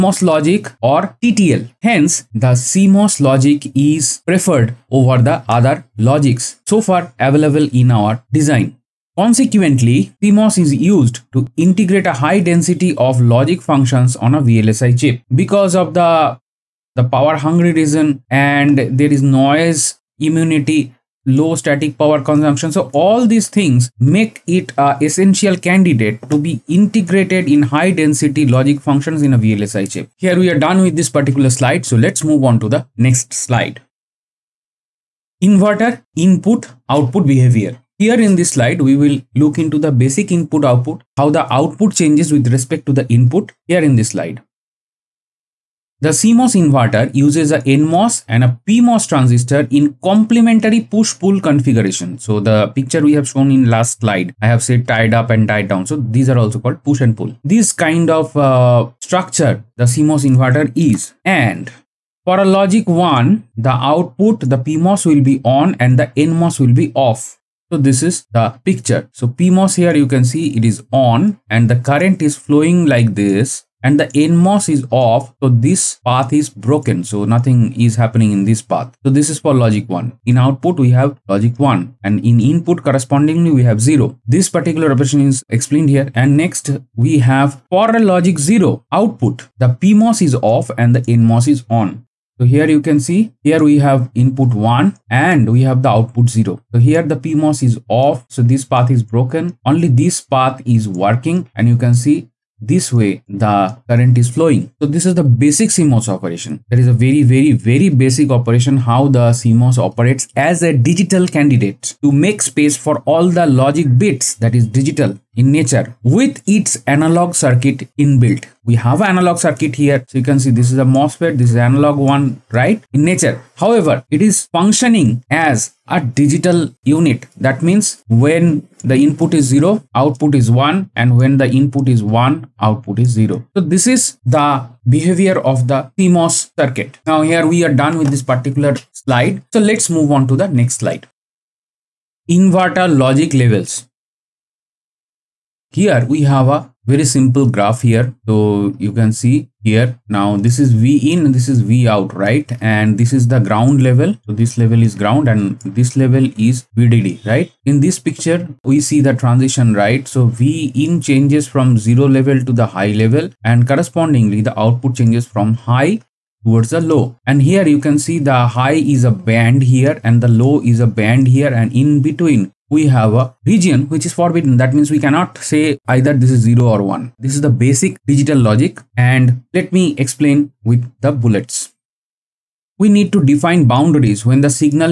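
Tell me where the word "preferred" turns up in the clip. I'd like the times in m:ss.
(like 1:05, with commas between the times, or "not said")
0:04.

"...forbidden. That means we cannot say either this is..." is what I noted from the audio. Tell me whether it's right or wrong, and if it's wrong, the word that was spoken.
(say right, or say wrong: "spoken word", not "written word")
right.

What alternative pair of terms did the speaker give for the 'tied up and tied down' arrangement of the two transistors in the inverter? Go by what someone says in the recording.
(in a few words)
push and pull.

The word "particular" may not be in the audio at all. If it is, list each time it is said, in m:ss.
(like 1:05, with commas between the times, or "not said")
0:31, 1:24, 2:18.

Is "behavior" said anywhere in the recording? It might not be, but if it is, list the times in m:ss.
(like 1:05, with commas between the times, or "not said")
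0:37, 2:14.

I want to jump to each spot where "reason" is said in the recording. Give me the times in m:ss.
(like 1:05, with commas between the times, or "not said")
0:17.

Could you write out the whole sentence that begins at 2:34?
So this level is ground and this level is VDD right.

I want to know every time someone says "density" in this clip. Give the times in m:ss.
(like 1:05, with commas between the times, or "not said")
0:12, 0:27.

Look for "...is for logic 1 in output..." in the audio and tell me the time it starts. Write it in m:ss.
1:19.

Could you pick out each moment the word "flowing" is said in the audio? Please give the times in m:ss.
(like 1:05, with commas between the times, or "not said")
1:12, 1:44.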